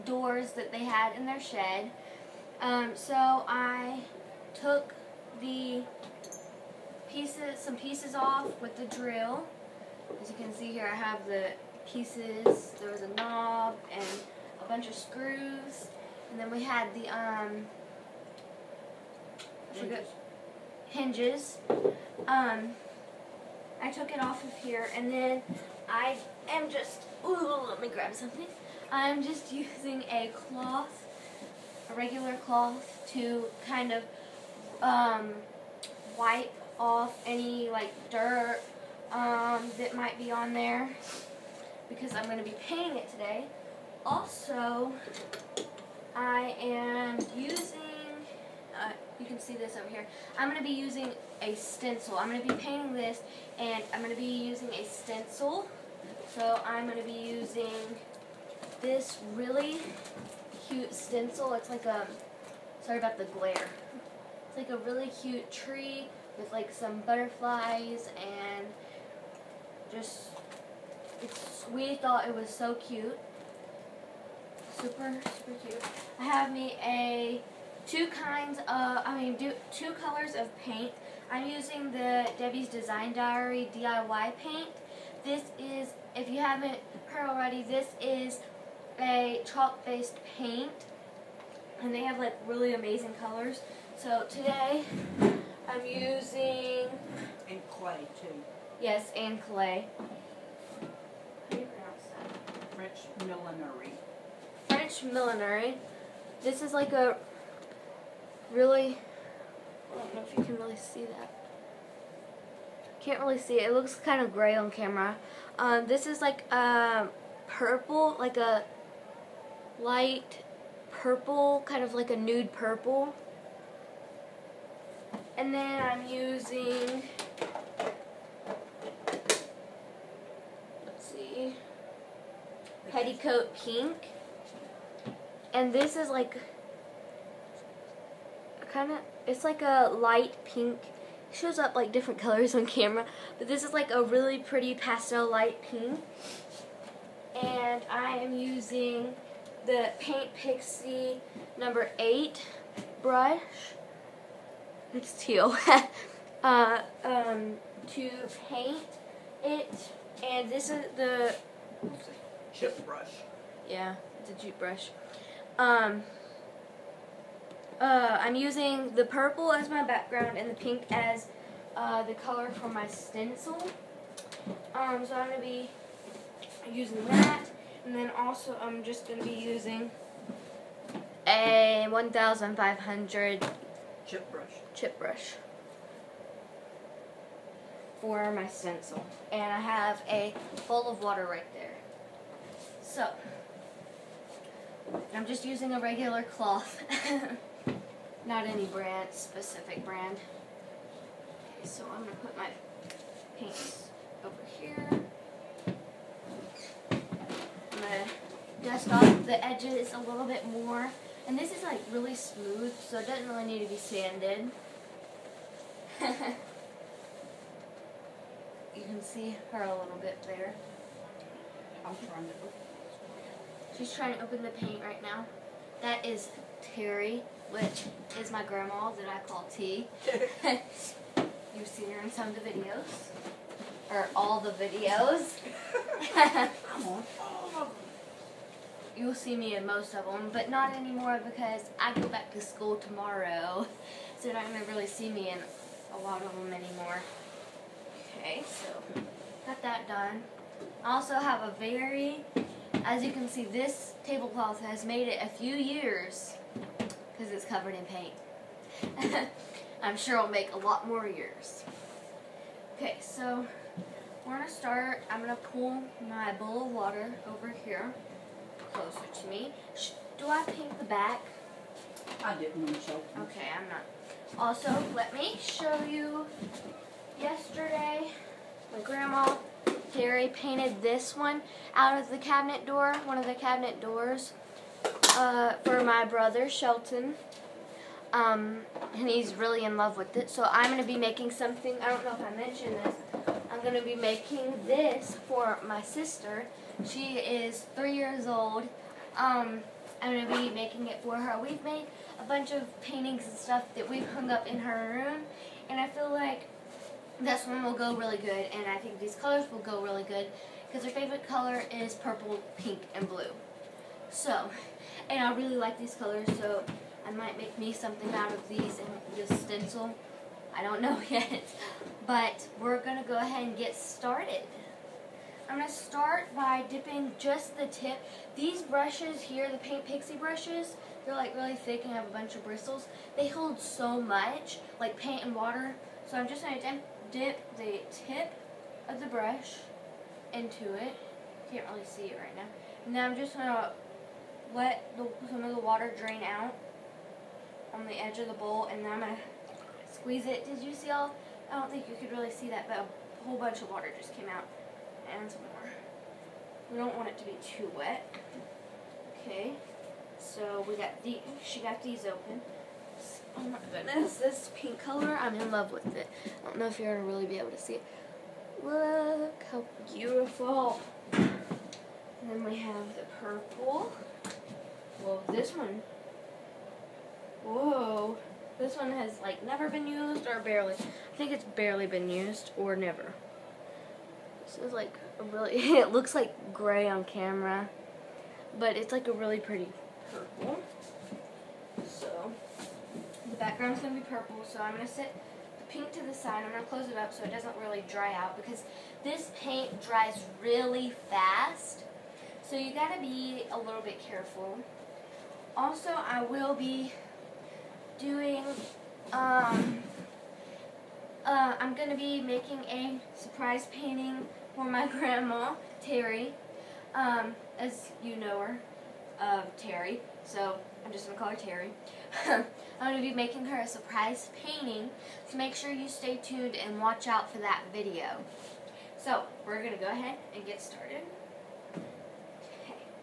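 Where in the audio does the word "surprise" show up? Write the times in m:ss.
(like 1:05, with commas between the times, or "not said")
6:53, 7:03.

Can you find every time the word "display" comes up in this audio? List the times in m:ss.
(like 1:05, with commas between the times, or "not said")
not said.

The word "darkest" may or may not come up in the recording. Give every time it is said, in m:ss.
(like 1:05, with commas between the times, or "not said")
not said.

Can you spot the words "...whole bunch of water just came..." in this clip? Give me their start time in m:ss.
5:53.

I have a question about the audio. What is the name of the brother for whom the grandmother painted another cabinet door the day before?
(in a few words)
Shelton.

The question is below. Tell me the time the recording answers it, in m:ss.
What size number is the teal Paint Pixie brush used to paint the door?
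2:31.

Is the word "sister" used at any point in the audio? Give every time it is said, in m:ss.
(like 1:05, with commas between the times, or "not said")
4:55.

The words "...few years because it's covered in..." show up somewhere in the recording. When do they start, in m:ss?
4:15.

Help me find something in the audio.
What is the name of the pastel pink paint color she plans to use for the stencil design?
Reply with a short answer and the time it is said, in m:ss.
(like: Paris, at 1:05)
Petticoat Pink, at 2:12.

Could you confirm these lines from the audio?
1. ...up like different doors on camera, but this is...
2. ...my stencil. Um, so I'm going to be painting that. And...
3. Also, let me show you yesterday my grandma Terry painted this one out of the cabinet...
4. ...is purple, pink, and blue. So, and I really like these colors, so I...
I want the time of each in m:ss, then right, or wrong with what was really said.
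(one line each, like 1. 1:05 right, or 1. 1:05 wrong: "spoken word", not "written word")
1. 2:21 wrong: "colors", not "doors"
2. 2:52 wrong: "using", not "painting"
3. 4:34 right
4. 5:11 right.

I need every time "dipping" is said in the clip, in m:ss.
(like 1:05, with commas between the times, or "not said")
5:26.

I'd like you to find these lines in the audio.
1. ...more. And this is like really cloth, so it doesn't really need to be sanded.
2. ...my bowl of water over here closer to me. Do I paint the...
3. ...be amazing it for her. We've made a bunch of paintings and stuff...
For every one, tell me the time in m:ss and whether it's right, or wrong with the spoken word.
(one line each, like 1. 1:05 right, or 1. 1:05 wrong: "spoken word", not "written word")
1. 3:30 wrong: "smooth", not "cloth"
2. 4:26 right
3. 5:00 wrong: "making", not "amazing".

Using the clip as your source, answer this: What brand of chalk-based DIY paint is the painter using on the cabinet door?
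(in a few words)
Debbie's Design Diary.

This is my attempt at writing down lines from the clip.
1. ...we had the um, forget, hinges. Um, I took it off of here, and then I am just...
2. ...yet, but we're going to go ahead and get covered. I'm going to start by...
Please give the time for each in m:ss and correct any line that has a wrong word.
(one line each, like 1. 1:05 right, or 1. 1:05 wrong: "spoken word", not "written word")
1. 0:16 right
2. 5:21 wrong: "started", not "covered".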